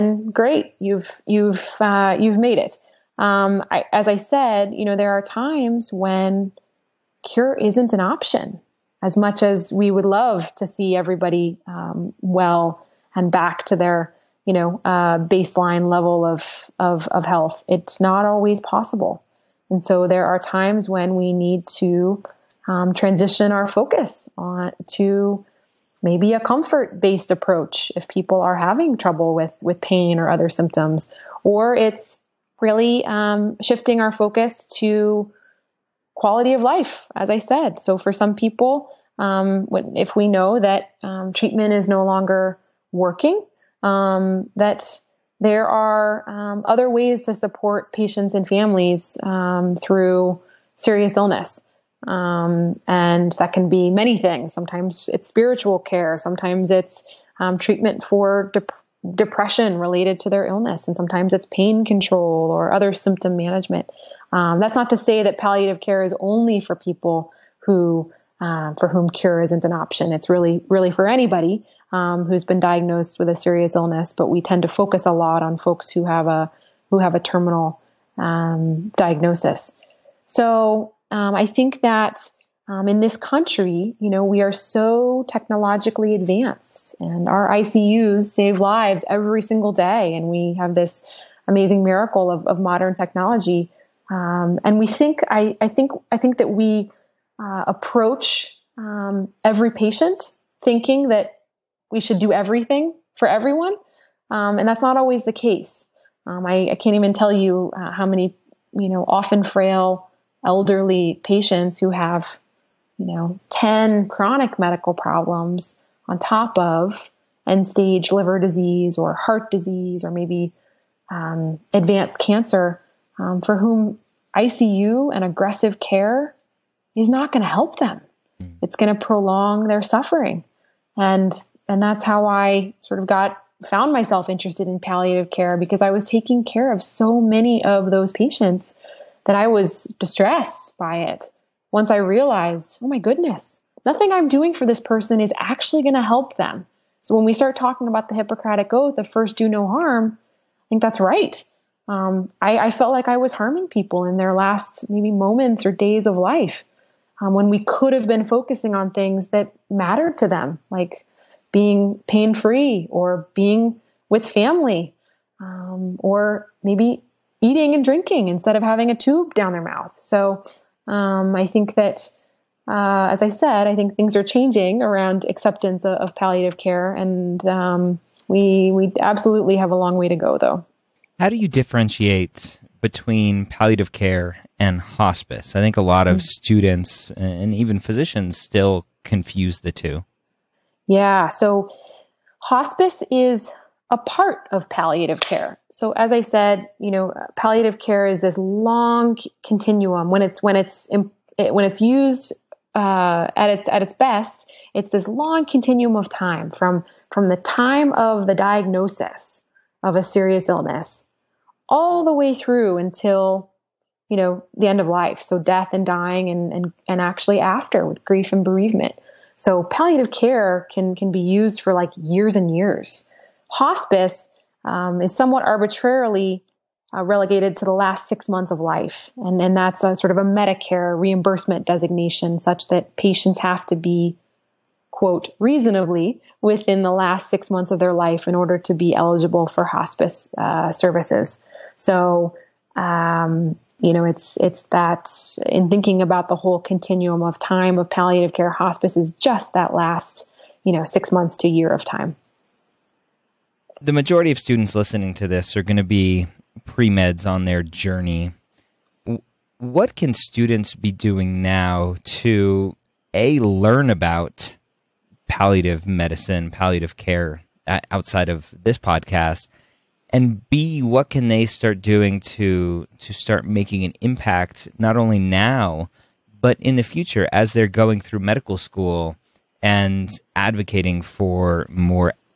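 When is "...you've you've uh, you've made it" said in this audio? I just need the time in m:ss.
0:00.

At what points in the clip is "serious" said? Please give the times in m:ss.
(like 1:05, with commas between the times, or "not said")
0:50, 1:13, 3:30.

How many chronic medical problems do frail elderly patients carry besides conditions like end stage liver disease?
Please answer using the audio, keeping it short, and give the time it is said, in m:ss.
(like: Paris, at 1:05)
10, at 1:53.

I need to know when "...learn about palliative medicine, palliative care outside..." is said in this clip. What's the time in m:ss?
4:23.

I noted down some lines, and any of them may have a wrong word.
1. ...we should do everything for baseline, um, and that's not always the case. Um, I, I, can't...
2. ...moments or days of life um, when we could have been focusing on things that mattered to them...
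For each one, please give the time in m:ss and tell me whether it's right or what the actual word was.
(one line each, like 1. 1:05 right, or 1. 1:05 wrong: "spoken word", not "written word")
1. 1:41 wrong: "everyone", not "baseline"
2. 2:35 right.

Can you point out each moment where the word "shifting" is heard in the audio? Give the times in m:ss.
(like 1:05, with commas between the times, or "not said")
0:33.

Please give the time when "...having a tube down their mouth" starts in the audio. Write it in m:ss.
2:48.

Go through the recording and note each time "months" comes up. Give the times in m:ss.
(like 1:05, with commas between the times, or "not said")
3:48, 3:57, 4:11.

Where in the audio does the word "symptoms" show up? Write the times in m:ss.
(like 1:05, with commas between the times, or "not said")
0:30, 1:02.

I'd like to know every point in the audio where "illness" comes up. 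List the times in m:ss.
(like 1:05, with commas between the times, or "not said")
0:51, 1:00, 1:13, 3:30.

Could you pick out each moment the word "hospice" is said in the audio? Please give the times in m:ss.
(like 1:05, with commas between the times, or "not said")
3:04, 3:12, 3:43, 3:59, 4:08.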